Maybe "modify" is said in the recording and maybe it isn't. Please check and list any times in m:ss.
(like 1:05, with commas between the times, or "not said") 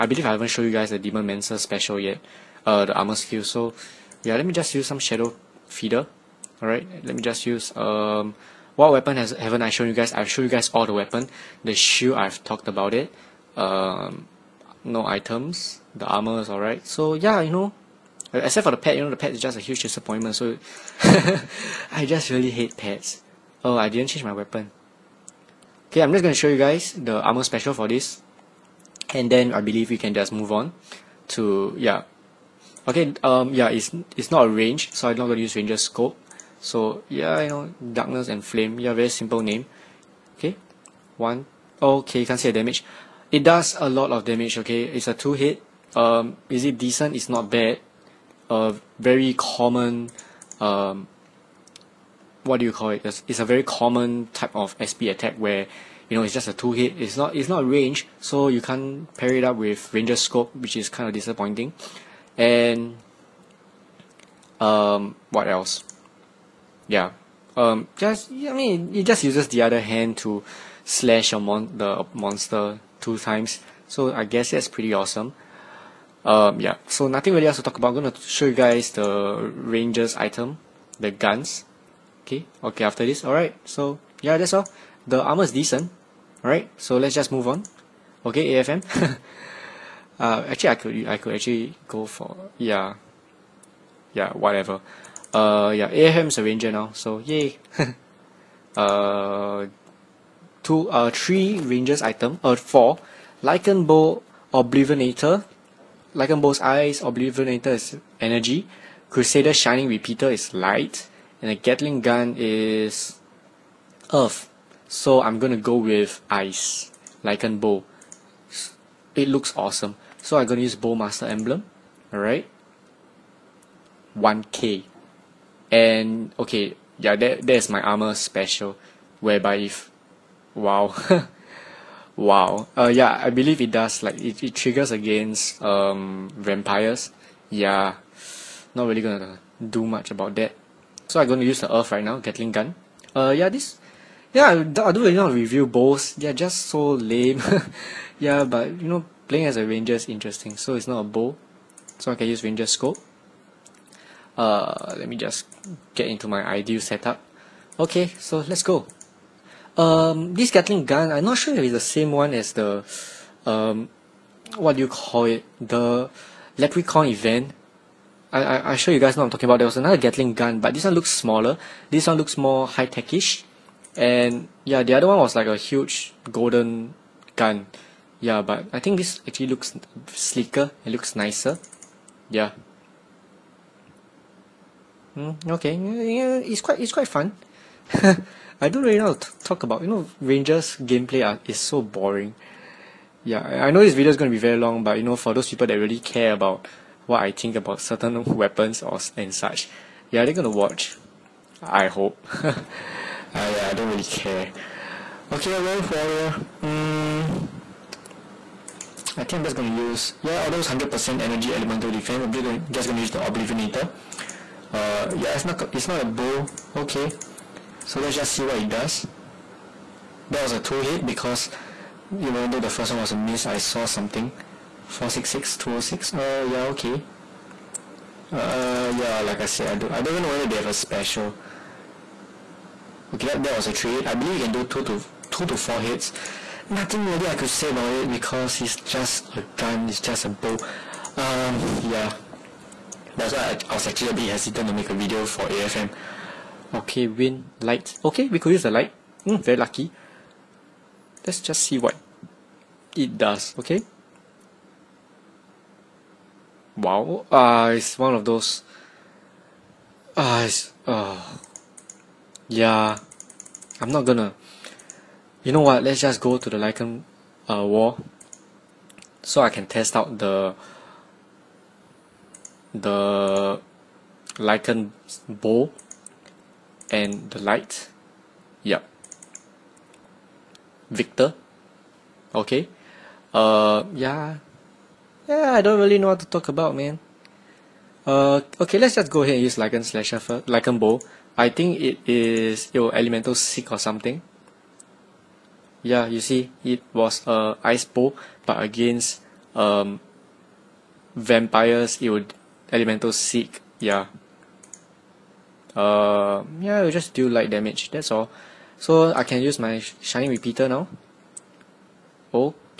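not said.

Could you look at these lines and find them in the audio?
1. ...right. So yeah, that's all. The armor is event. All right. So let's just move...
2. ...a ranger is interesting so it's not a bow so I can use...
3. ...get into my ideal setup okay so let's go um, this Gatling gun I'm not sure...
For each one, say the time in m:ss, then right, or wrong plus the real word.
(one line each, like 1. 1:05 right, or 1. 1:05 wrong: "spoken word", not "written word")
1. 1:23 wrong: "decent", not "event"
2. 2:29 right
3. 2:35 right.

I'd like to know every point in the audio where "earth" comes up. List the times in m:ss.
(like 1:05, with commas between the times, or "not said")
1:54, 2:21.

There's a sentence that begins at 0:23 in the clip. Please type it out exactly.
Oh, I didn't change my weapon.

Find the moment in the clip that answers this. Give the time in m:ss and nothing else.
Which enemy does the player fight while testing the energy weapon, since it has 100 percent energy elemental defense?
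3:25.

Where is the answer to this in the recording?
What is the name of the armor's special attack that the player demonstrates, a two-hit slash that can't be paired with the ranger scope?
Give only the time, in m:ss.
0:37.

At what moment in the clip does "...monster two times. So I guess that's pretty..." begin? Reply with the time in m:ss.
1:12.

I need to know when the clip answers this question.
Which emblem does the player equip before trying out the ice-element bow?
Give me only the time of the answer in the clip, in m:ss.
2:00.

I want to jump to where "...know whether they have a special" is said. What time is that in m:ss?
3:50.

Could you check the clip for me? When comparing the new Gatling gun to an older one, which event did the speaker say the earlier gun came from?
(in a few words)
Leprechaun event.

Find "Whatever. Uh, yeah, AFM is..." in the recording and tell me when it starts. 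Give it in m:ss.
1:34.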